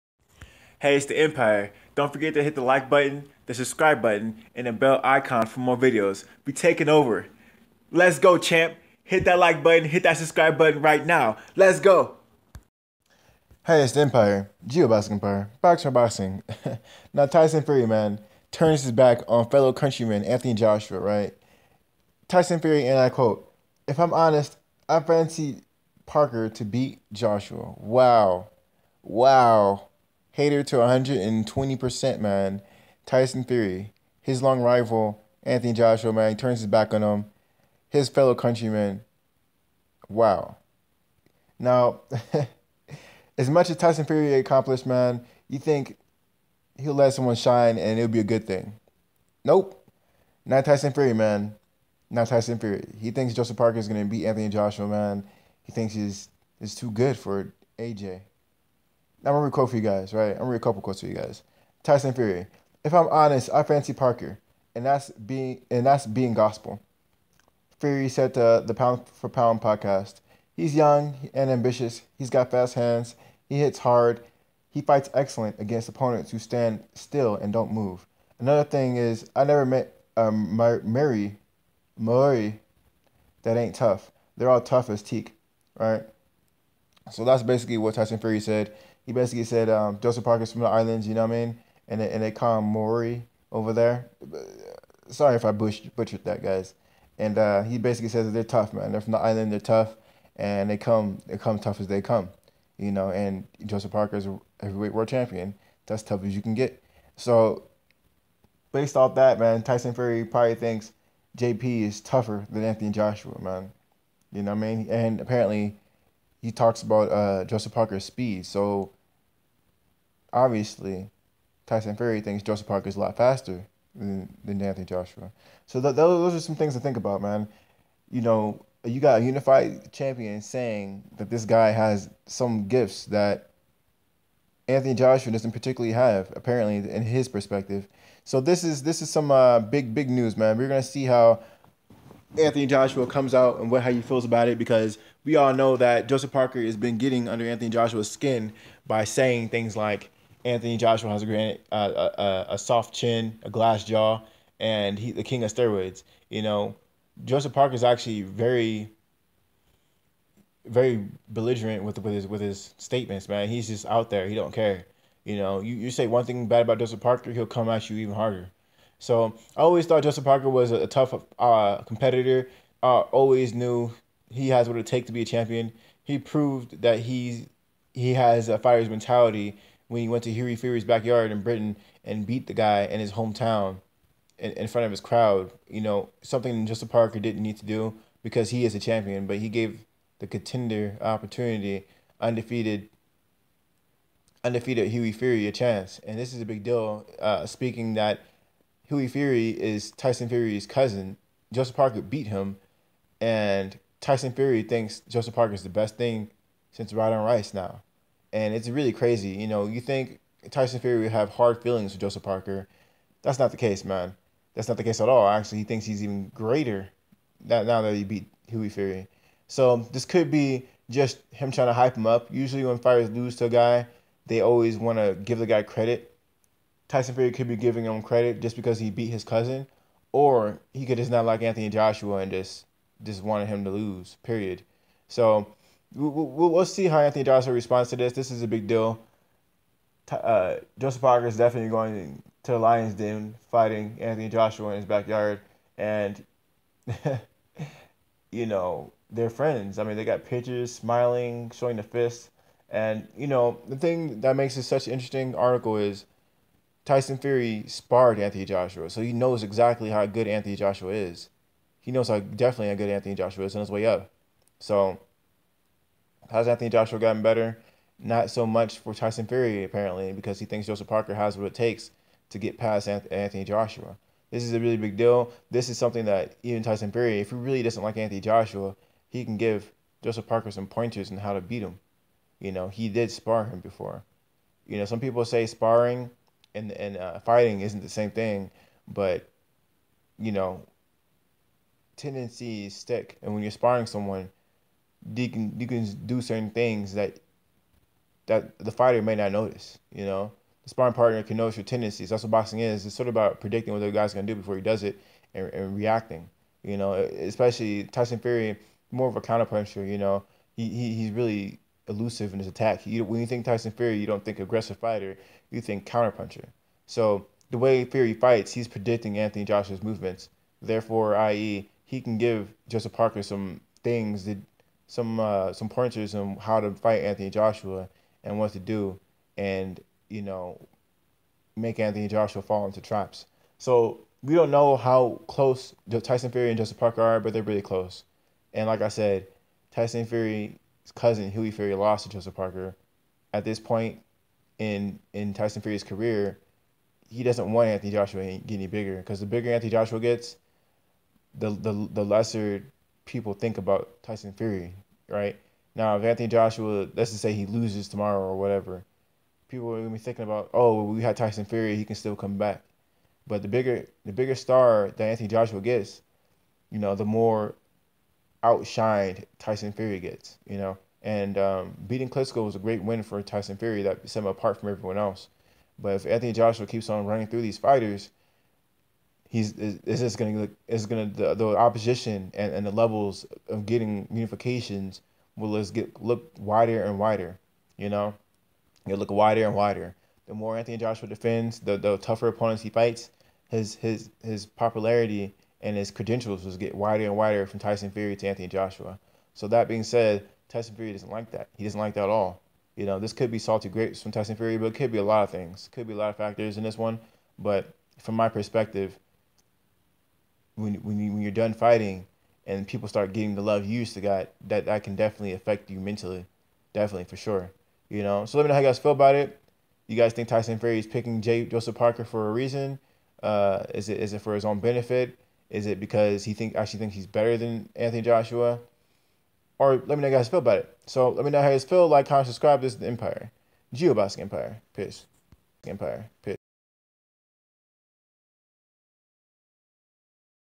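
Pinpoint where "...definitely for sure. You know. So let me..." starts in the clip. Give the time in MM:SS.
06:56.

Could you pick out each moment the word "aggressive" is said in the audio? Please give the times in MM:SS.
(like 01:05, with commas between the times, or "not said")
05:14.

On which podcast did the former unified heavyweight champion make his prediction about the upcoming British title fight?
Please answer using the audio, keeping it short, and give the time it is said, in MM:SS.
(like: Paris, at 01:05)
Pound for Pound, at 01:08.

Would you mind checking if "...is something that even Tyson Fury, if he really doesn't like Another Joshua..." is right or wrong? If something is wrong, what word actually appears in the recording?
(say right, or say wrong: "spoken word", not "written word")
wrong: "Anthony", not "Another".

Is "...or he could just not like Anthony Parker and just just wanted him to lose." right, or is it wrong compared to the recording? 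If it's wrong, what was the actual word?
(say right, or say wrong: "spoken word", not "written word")
wrong: "Joshua", not "Parker".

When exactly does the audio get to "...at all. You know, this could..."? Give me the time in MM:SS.
06:42.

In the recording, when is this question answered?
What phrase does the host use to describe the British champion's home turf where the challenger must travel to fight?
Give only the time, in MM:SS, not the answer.
04:02.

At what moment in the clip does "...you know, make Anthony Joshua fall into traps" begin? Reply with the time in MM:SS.
05:30.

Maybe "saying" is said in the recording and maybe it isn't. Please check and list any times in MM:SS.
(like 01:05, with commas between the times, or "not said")
02:10, 02:29.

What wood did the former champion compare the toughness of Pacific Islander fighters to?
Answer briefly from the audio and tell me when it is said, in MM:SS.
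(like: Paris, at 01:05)
Teak, at 01:24.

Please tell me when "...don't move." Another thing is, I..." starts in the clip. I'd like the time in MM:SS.
01:17.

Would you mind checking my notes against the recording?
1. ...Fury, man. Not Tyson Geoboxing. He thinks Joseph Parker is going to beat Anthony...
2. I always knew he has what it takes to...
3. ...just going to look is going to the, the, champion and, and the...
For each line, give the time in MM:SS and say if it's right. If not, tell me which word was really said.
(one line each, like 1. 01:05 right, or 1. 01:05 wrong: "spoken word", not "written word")
1. 00:50 wrong: "Fury", not "Geoboxing"
2. 02:52 right
3. 06:19 wrong: "opposition", not "champion".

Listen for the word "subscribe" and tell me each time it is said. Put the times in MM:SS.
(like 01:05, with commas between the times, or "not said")
00:03, 00:10, 07:12.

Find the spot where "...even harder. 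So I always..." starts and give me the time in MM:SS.
02:47.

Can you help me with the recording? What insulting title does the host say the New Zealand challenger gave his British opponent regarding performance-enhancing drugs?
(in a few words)
King of steroids.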